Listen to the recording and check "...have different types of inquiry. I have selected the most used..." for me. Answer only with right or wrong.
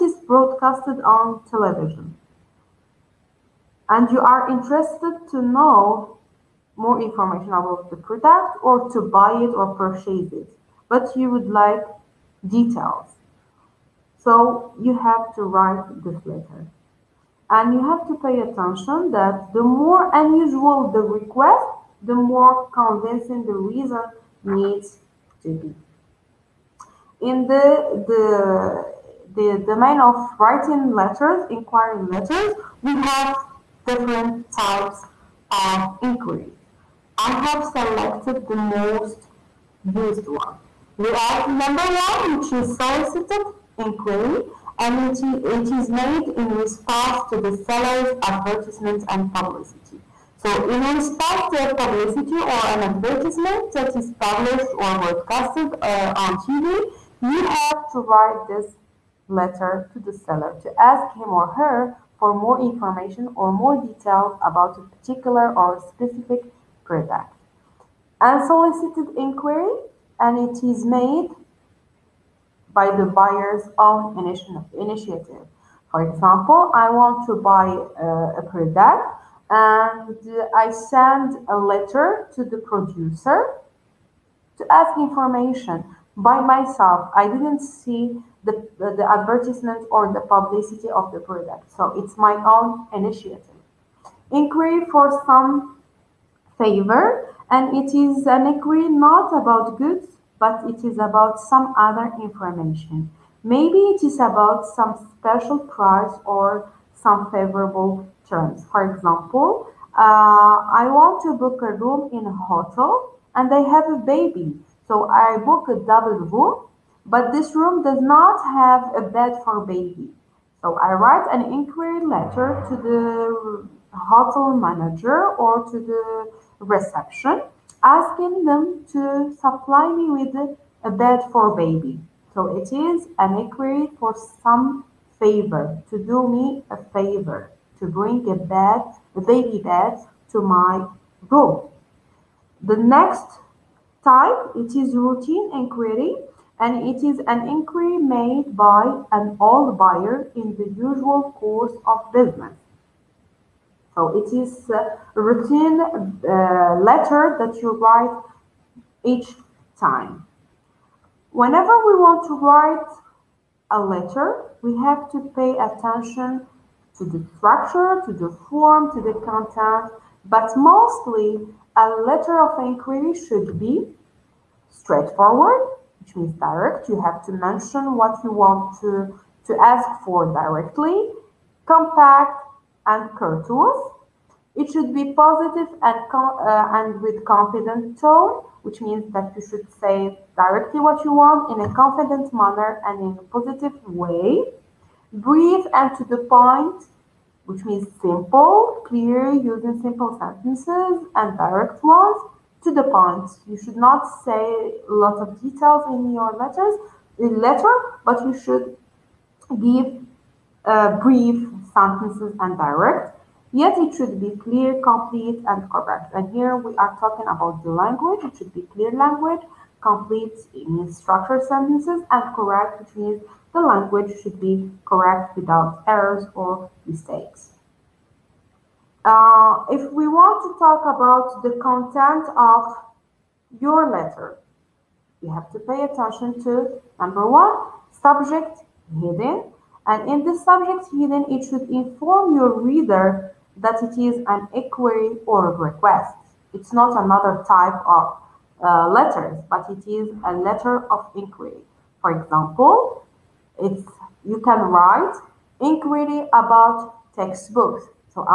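right.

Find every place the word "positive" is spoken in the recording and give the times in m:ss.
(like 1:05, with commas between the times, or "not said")
3:05, 3:13.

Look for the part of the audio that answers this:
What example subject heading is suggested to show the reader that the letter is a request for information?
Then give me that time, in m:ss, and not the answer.
4:15.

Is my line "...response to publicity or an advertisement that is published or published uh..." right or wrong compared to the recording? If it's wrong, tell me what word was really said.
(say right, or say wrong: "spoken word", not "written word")
wrong: "broadcasted", not "published".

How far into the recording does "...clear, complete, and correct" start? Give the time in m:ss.
3:34.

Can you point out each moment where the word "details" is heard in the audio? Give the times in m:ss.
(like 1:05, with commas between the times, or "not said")
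0:12, 1:03, 3:25.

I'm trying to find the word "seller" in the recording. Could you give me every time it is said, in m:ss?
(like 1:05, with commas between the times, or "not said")
0:47, 1:00.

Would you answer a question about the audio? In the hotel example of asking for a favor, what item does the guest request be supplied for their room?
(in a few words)
A baby bed.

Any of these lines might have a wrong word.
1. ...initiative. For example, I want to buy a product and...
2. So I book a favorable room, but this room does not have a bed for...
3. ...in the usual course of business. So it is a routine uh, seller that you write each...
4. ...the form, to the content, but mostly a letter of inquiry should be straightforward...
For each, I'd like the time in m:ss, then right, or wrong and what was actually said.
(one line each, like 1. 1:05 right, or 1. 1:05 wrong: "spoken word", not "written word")
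1. 1:14 right
2. 1:54 wrong: "double", not "favorable"
3. 2:30 wrong: "letter", not "seller"
4. 2:48 right.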